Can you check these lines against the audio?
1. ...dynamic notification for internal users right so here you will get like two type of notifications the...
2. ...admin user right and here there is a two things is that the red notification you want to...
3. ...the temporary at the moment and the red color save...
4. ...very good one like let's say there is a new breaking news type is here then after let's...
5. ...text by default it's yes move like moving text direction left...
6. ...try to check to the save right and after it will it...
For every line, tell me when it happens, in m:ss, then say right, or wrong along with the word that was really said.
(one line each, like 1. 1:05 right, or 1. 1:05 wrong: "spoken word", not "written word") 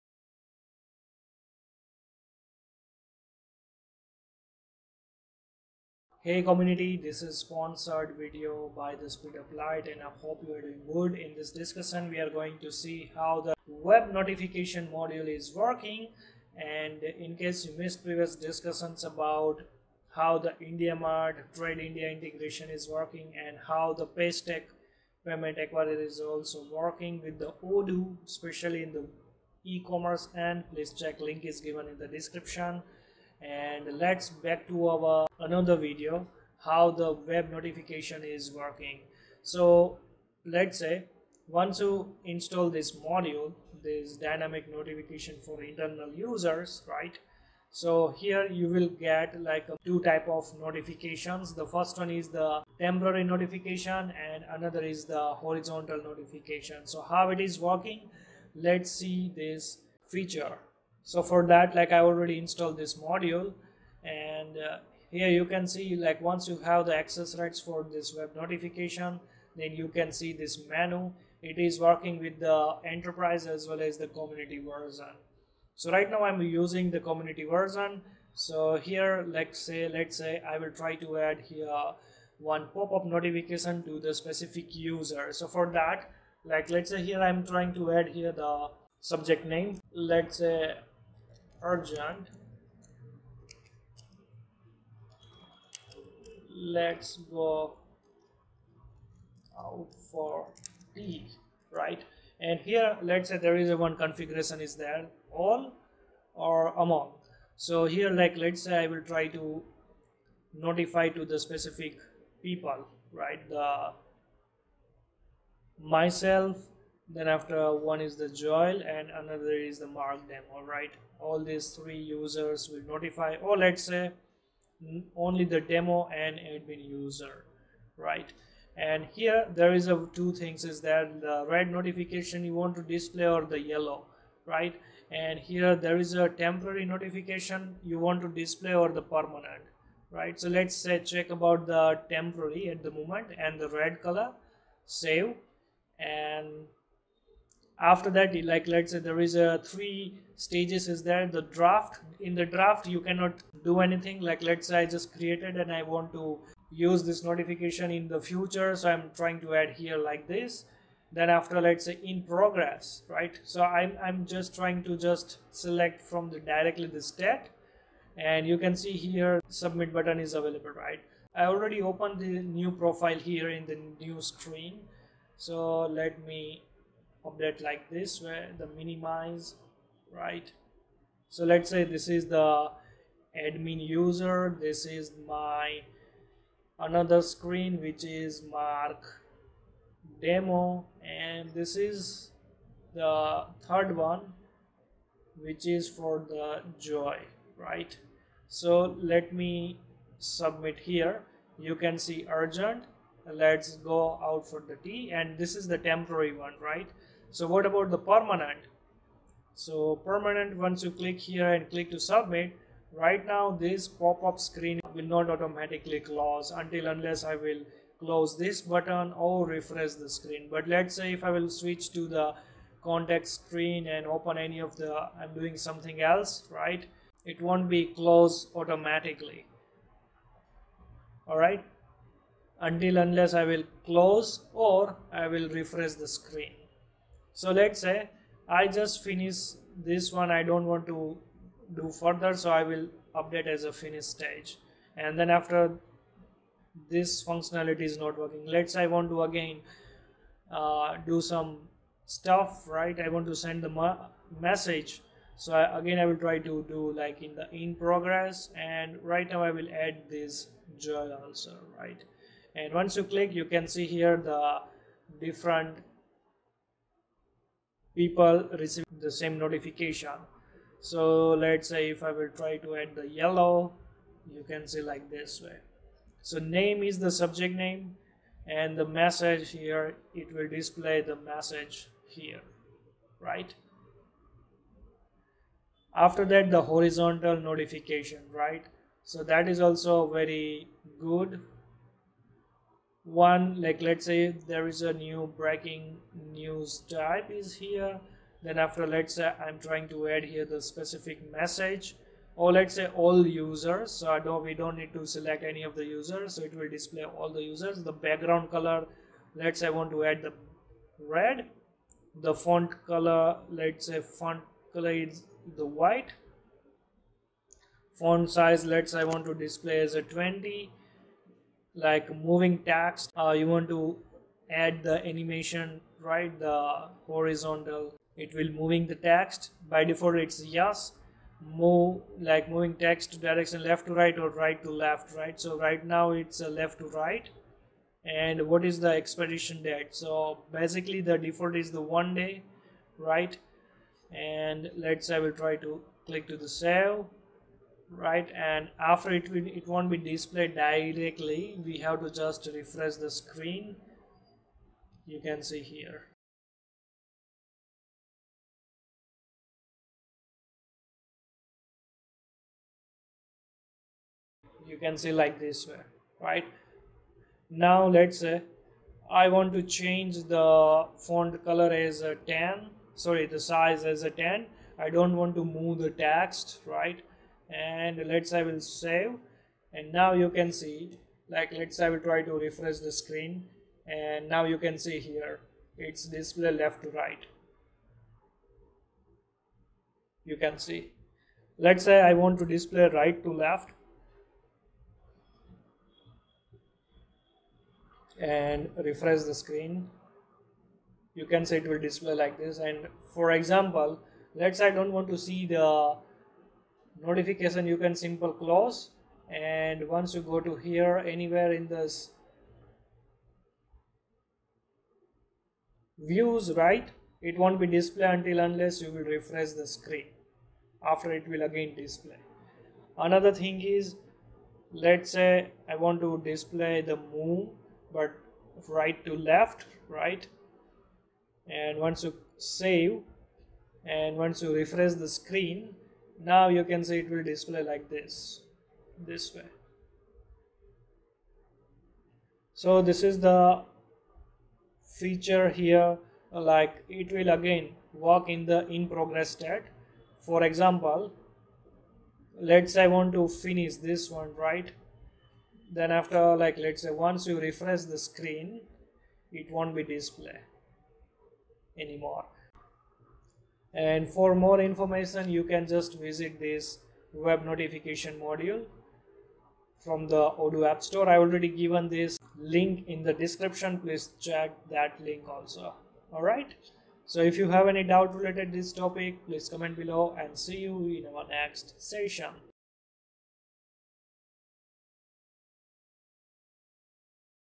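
1. 0:44 right
2. 2:06 right
3. 2:21 right
4. 4:50 right
5. 5:28 right
6. 5:45 wrong: "click", not "check".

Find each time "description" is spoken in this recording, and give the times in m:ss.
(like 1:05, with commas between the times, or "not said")
0:32, 7:53.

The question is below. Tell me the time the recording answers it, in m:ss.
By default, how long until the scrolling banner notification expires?
5:41.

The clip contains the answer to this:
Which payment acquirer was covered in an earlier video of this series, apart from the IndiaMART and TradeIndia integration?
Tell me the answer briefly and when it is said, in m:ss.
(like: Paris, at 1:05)
Paystack, at 0:24.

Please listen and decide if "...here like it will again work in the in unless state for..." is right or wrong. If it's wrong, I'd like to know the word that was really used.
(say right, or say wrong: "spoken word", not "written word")
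wrong: "progress", not "unless".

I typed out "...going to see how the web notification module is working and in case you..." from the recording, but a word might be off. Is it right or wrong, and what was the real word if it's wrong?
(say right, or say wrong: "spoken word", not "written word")
right.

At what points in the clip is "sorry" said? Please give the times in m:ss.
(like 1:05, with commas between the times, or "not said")
6:12.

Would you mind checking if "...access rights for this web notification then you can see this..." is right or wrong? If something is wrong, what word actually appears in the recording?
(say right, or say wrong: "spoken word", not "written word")
right.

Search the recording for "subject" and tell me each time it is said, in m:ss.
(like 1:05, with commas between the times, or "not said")
1:29, 4:37.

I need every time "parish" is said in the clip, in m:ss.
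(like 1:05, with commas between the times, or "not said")
not said.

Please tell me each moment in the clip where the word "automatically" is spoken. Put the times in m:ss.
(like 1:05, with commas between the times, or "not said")
3:35, 3:48.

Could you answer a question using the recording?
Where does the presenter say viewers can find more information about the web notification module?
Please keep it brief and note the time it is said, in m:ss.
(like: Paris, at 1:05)
Odoo app store, at 7:50.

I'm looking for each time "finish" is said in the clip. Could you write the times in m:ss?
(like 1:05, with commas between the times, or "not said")
3:59, 4:03, 7:33.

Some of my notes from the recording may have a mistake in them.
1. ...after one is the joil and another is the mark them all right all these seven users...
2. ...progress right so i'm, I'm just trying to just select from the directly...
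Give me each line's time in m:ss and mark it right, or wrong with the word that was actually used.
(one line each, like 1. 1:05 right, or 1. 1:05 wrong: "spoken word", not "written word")
1. 1:57 wrong: "three", not "seven"
2. 2:42 right.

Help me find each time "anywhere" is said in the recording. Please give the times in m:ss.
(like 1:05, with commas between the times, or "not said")
6:51.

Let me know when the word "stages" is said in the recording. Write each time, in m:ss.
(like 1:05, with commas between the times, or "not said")
2:30, 4:04.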